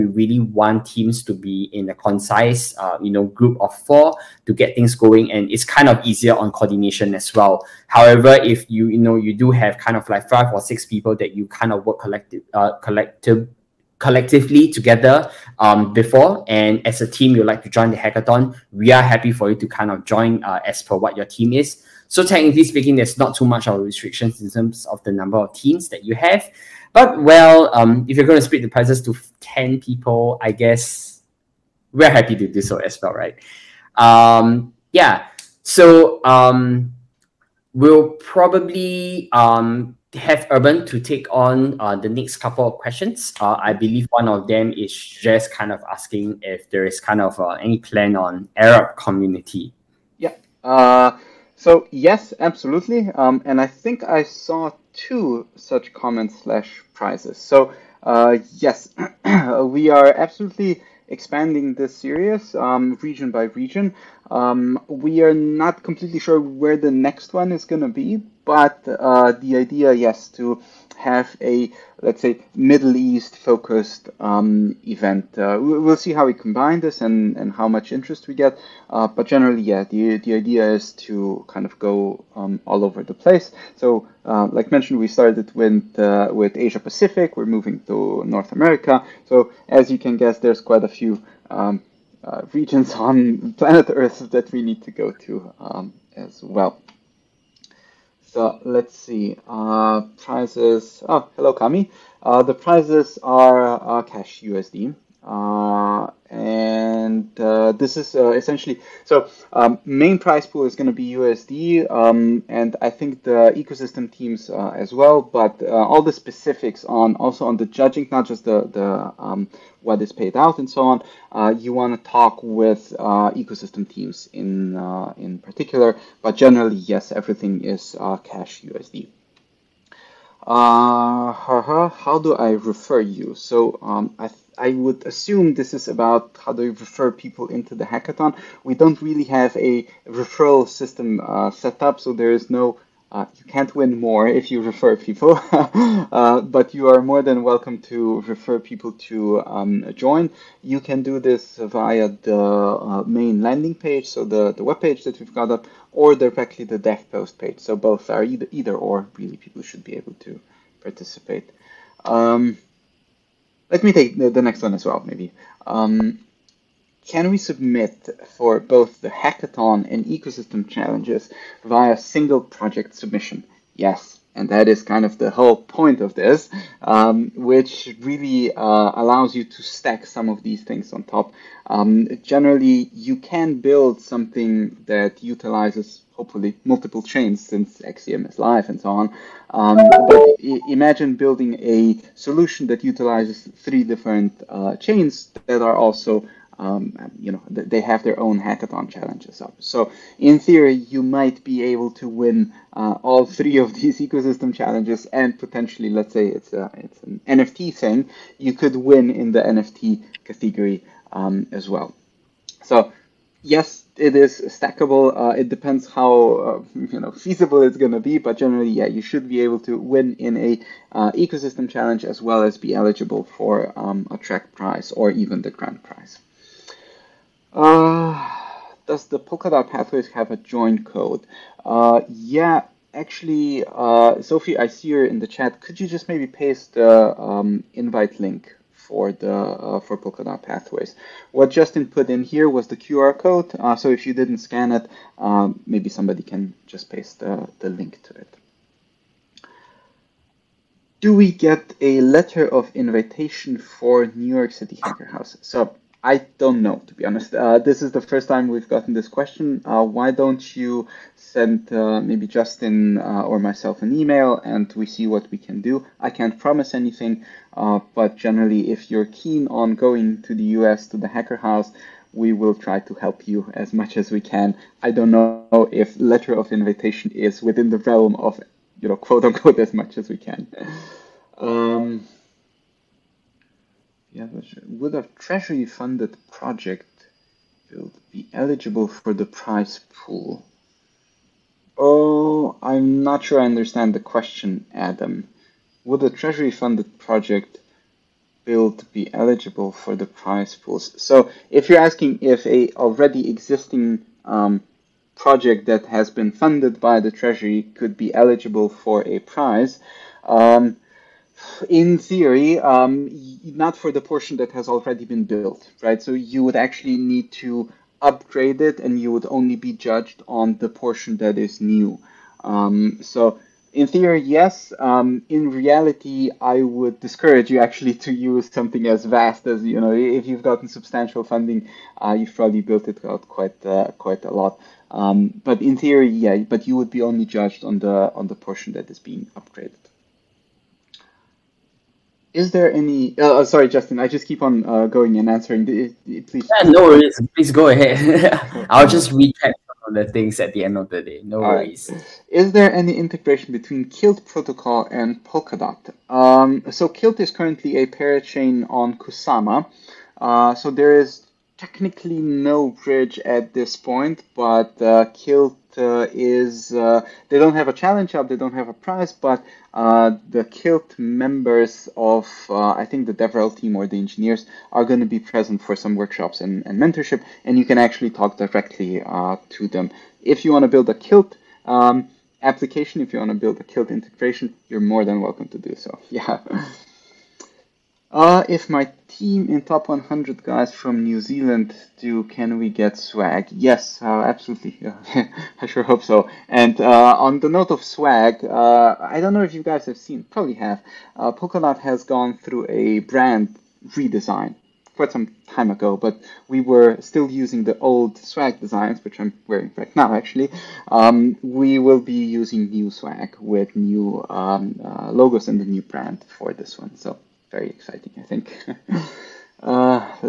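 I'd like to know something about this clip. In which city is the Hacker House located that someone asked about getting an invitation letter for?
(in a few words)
New York City.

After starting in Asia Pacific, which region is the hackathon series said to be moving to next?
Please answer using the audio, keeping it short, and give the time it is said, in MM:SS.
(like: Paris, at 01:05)
North America, at 01:28.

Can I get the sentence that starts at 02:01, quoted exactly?
Uh, you want to talk with uh, ecosystem teams in uh, in particular, but generally, yes, everything is cash USD.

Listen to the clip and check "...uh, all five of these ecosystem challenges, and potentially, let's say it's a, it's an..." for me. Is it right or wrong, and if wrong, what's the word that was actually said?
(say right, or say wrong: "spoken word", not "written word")
wrong: "three", not "five".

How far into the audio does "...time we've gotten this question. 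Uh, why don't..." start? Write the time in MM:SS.
04:18.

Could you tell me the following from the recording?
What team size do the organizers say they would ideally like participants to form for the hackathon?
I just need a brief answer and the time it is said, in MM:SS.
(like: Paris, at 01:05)
4, at 00:03.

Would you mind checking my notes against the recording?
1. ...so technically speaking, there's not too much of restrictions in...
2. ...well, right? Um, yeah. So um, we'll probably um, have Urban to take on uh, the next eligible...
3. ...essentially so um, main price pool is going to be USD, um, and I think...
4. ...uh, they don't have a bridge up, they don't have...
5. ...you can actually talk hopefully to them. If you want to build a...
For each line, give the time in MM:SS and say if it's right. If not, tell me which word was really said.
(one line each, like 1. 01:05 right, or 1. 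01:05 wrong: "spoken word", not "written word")
1. 00:22 right
2. 00:33 wrong: "couple", not "eligible"
3. 01:48 right
4. 06:06 wrong: "challenge", not "bridge"
5. 06:17 wrong: "directly", not "hopefully".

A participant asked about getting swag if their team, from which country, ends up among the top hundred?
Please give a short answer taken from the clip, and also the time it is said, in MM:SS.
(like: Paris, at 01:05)
New Zealand, at 06:31.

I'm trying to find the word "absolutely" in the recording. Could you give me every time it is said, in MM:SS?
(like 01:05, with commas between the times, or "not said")
00:52, 01:00, 06:34.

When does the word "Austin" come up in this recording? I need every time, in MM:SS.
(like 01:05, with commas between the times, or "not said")
not said.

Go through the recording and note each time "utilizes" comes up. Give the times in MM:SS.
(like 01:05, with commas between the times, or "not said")
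03:05, 03:12.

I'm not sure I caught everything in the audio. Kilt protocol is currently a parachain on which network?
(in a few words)
Kusama.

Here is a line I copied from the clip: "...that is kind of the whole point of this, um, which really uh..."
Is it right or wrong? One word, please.
right.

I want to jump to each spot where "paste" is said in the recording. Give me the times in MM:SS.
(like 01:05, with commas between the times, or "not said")
03:56, 04:06.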